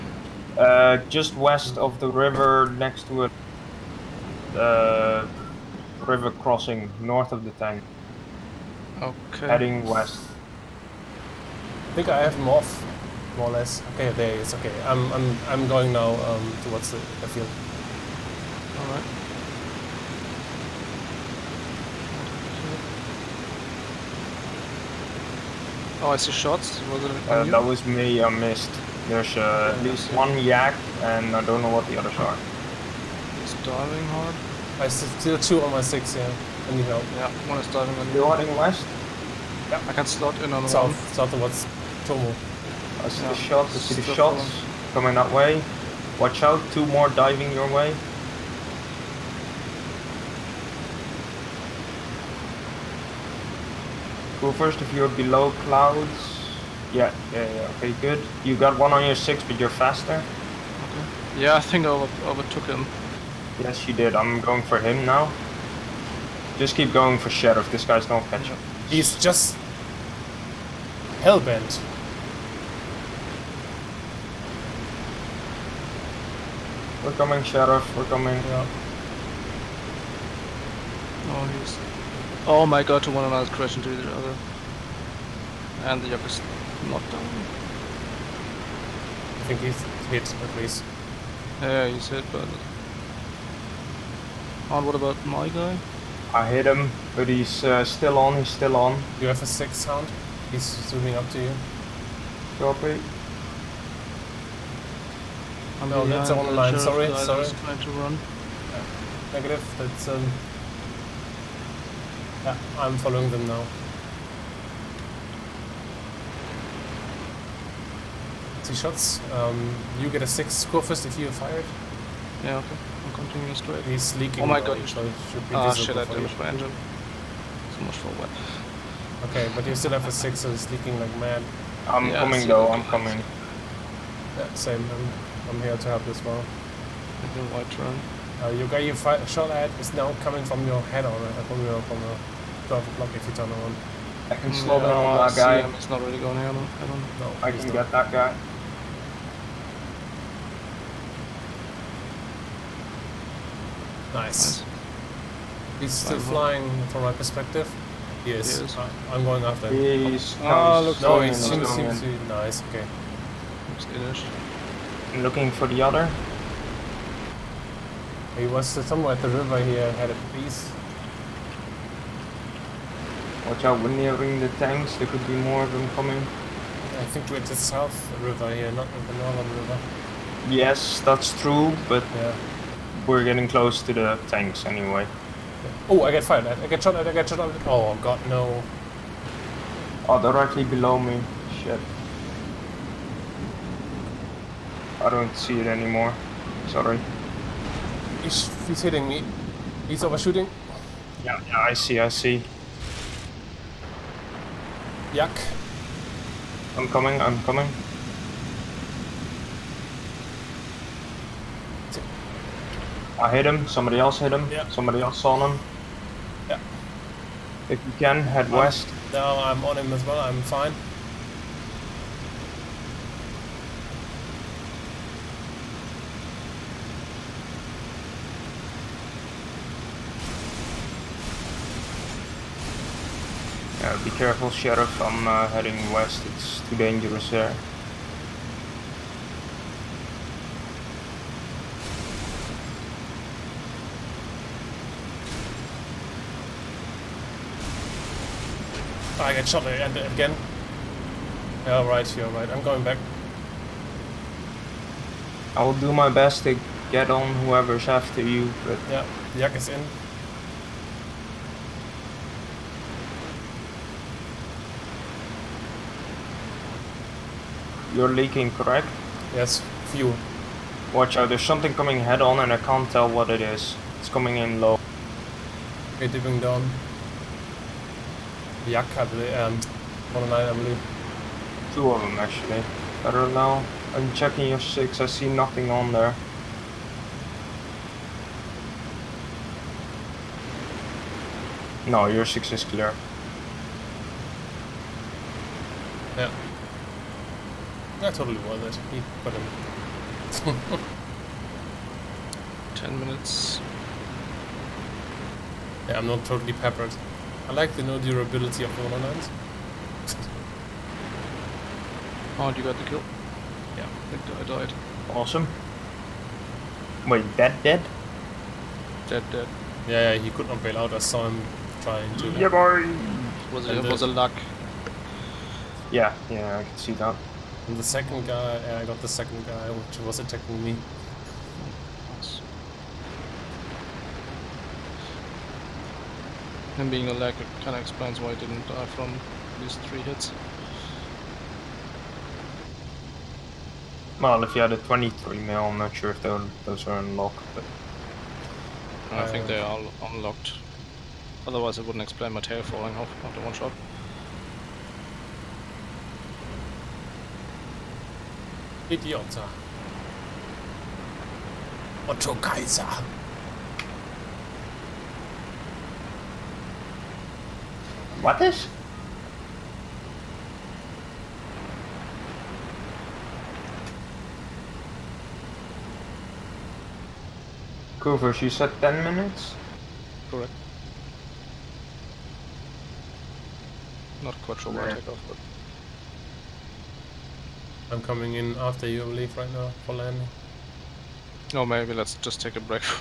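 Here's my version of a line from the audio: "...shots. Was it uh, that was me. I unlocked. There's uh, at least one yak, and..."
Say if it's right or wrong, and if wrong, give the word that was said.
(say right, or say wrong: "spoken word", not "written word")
wrong: "missed", not "unlocked".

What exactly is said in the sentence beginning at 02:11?
I'm yeah, coming though, I'm coming.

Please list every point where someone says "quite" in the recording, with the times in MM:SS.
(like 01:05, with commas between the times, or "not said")
06:24.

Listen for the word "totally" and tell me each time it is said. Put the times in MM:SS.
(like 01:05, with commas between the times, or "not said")
04:58, 05:06.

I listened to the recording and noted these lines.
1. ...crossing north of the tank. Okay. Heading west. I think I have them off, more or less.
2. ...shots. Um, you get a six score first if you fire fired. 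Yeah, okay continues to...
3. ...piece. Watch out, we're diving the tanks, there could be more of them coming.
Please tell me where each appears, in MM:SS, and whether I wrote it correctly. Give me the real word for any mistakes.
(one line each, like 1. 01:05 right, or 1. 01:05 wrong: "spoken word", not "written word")
1. 00:06 right
2. 01:58 right
3. 02:50 wrong: "nearing", not "diving".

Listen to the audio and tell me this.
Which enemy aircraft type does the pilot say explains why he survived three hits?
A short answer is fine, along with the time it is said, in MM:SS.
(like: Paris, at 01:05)
LaGG, at 05:37.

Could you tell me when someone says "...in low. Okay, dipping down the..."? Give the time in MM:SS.
04:34.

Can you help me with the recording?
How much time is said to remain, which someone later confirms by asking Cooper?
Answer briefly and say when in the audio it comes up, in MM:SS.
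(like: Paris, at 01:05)
10 minutes, at 05:02.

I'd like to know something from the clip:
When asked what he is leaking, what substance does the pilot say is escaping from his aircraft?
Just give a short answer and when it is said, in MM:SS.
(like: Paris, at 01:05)
Fuel, at 04:29.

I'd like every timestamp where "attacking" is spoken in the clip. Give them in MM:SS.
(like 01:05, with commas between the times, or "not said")
05:30.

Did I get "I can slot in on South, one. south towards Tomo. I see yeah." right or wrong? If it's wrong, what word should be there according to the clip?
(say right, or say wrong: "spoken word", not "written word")
right.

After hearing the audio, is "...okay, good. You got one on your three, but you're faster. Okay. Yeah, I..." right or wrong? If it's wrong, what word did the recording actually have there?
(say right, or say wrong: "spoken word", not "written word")
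wrong: "six", not "three".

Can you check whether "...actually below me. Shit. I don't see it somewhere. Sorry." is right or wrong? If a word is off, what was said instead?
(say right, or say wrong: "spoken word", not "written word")
wrong: "anymore", not "somewhere".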